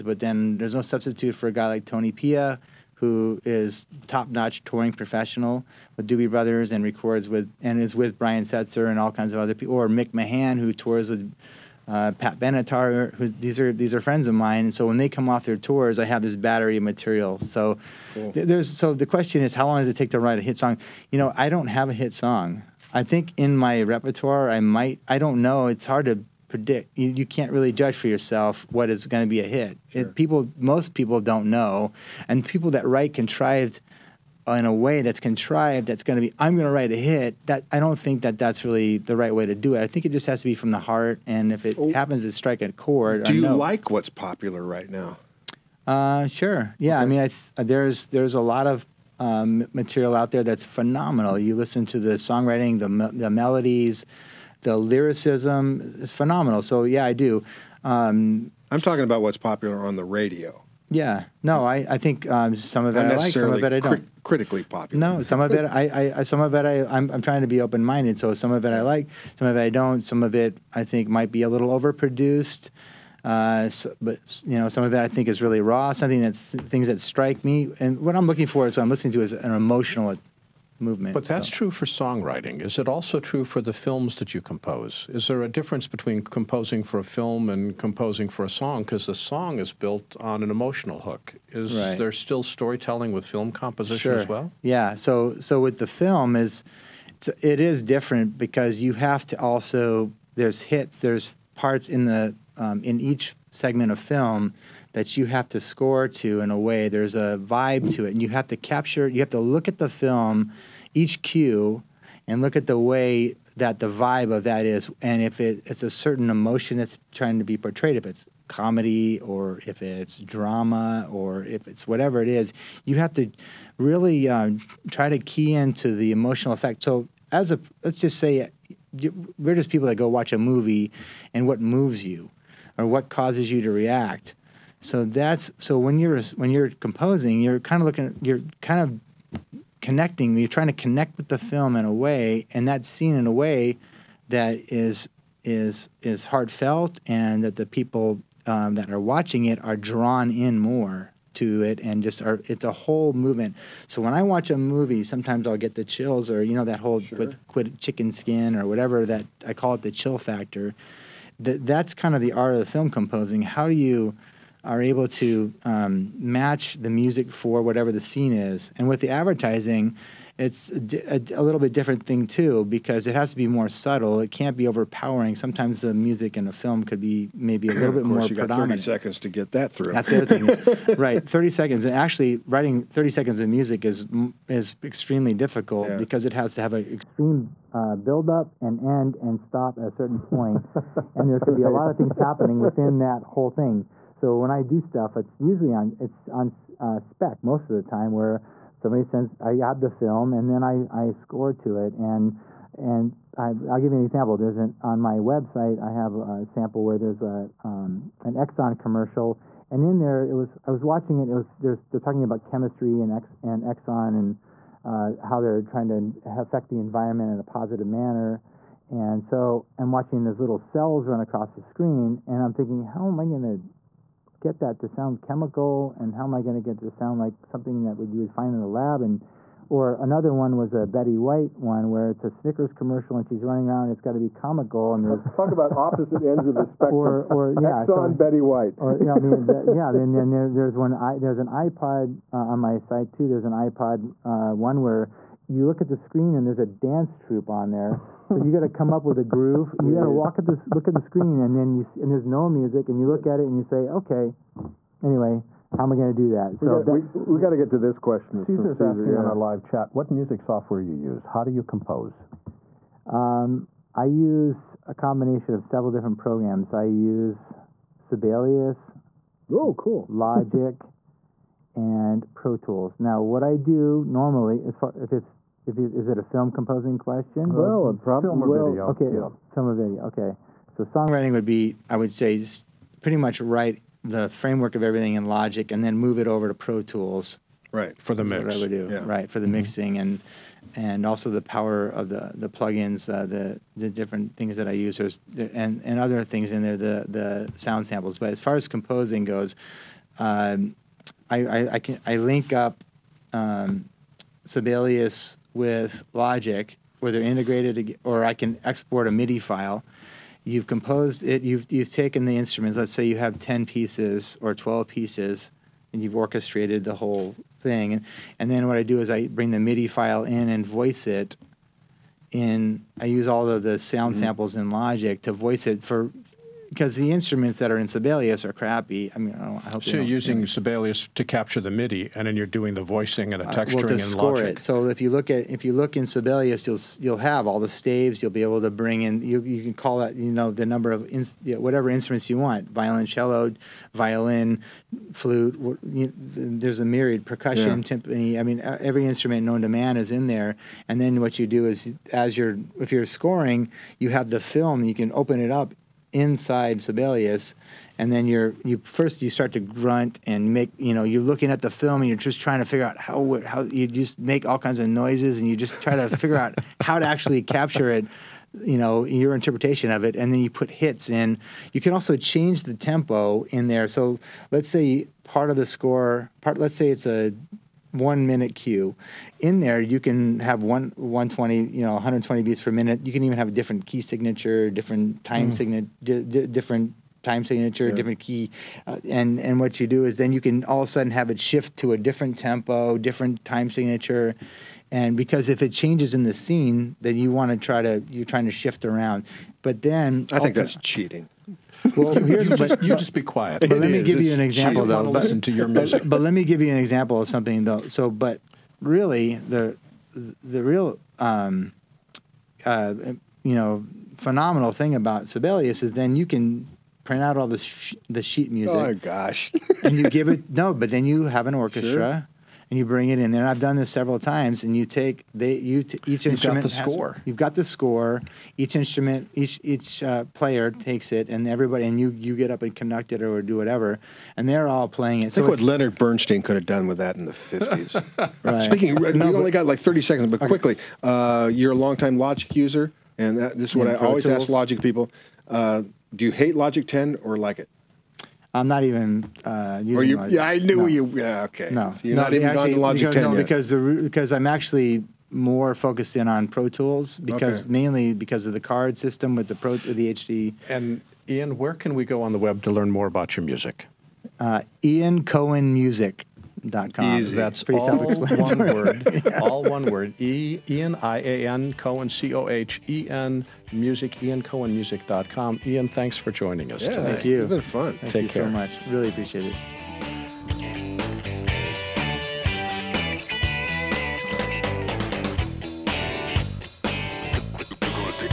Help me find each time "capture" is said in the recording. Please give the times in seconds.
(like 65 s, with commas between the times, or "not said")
108 s, 331 s, 367 s.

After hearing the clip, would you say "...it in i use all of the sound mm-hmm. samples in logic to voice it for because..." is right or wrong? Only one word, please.
right.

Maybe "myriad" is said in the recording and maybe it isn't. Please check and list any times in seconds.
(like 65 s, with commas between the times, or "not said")
346 s.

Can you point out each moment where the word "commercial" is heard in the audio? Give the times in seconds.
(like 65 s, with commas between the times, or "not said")
208 s, 232 s.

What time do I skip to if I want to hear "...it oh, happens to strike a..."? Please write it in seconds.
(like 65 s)
41 s.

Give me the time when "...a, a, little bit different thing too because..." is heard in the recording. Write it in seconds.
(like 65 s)
170 s.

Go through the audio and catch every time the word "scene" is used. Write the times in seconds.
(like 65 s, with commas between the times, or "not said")
142 s, 168 s, 396 s.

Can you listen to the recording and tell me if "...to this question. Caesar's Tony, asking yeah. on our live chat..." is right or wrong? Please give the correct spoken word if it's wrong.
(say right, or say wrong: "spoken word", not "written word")
wrong: "Caesar", not "Tony".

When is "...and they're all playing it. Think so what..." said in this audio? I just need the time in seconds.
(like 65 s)
434 s.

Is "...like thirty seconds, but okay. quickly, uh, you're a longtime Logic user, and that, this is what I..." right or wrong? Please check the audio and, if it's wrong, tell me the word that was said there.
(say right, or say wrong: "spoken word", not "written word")
right.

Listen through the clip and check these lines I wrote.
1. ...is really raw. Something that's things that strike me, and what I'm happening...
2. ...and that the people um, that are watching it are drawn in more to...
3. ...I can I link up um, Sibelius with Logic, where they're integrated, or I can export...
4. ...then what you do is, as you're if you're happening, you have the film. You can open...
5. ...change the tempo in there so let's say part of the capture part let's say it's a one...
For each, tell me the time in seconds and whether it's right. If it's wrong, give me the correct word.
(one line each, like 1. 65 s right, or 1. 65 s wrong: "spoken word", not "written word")
1. 75 s wrong: "looking", not "happening"
2. 147 s right
3. 301 s right
4. 351 s wrong: "scoring", not "happening"
5. 372 s wrong: "score", not "capture".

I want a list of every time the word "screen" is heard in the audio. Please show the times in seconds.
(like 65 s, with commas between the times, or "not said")
221 s, 245 s, 251 s.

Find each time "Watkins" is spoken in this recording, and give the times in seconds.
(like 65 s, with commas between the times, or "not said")
not said.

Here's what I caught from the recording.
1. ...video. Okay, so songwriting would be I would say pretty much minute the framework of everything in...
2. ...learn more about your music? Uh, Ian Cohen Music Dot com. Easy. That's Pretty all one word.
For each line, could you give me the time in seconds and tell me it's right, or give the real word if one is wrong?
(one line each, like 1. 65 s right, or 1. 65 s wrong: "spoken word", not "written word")
1. 279 s wrong: "write", not "minute"
2. 462 s right.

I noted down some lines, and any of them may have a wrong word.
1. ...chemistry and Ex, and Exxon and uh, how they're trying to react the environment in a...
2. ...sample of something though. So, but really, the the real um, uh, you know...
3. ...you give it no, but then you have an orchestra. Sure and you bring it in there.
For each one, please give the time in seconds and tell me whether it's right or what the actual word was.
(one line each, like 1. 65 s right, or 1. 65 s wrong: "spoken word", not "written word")
1. 212 s wrong: "affect", not "react"
2. 406 s wrong: "example", not "sample"
3. 419 s right.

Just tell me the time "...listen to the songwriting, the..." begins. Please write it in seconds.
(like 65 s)
51 s.